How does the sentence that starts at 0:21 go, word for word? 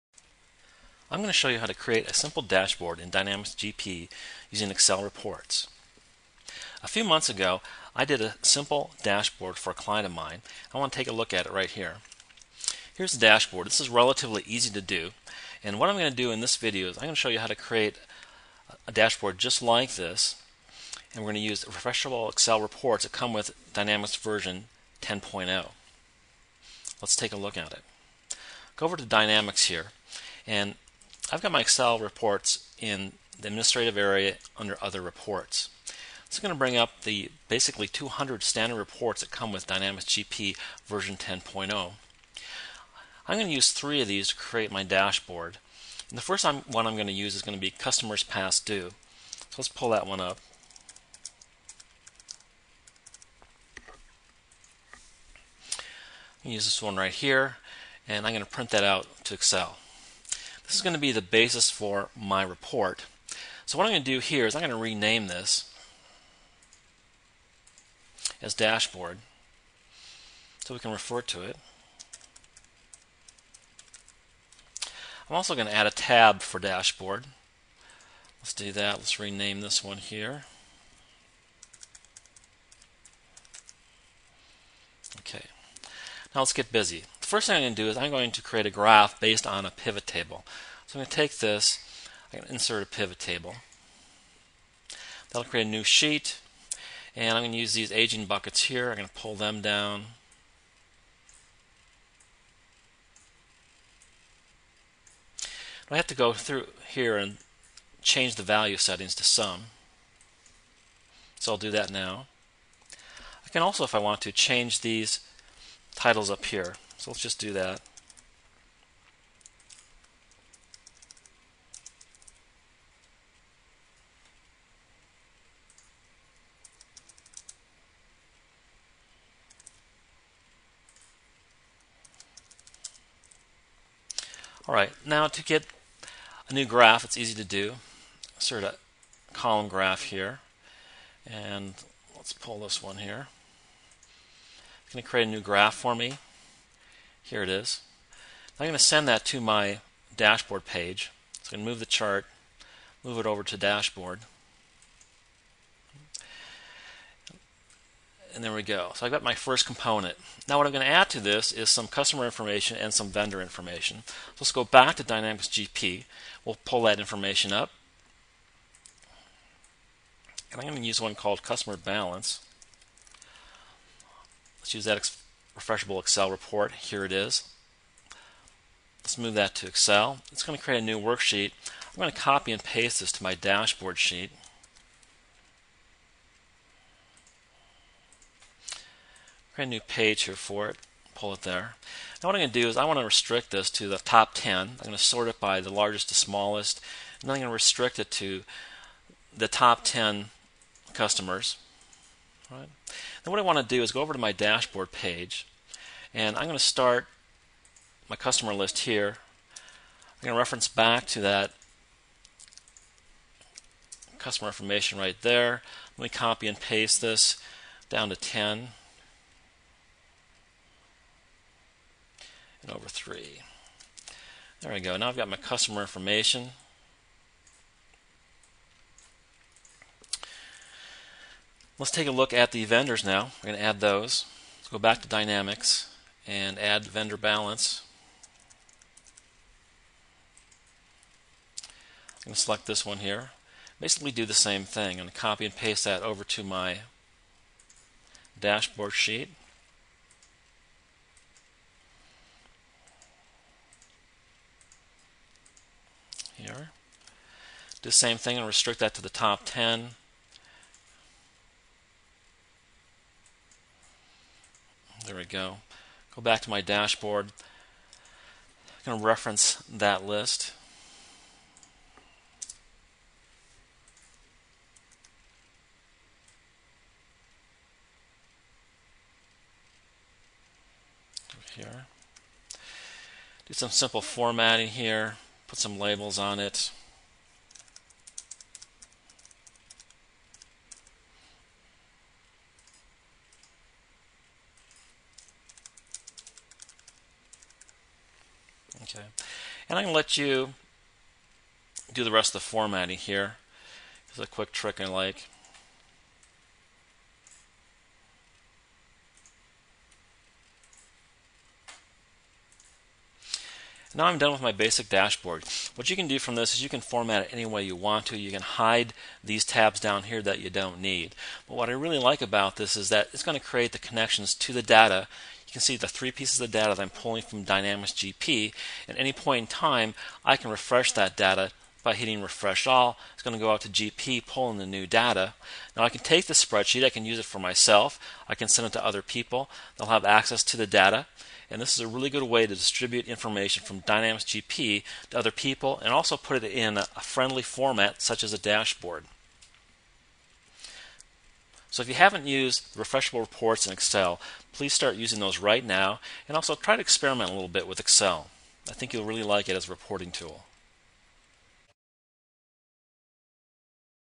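And we're going to use refreshable Excel reports that come with Dynamics version 10.0.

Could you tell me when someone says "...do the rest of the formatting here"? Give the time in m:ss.
5:01.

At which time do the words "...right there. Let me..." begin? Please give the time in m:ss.
3:34.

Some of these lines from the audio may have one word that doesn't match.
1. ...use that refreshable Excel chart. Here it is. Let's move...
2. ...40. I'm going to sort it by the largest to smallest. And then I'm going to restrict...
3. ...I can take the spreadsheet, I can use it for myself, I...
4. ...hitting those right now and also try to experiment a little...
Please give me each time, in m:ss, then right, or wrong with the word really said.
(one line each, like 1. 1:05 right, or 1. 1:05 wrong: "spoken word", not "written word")
1. 2:54 wrong: "report", not "chart"
2. 3:14 wrong: "10", not "40"
3. 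5:35 right
4. 5:54 wrong: "using", not "hitting".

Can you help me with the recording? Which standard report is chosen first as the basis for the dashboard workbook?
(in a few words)
customers past due.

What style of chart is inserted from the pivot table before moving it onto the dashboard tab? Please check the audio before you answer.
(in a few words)
column graph.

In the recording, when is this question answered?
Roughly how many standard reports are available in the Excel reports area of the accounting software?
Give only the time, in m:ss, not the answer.
0:37.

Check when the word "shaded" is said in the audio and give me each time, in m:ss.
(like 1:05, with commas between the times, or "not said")
not said.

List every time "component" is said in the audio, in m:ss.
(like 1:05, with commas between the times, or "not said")
2:39.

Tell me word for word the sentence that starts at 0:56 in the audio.
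use this one right here and I'm going to print that out to Excel.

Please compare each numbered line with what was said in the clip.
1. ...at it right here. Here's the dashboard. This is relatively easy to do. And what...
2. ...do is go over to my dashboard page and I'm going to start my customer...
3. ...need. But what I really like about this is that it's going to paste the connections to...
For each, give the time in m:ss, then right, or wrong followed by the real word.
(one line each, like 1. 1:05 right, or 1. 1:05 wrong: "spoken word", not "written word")
1. 0:11 right
2. 3:23 right
3. 5:20 wrong: "create", not "paste".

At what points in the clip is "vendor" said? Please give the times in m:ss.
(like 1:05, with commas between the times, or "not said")
2:43, 3:52, 3:56.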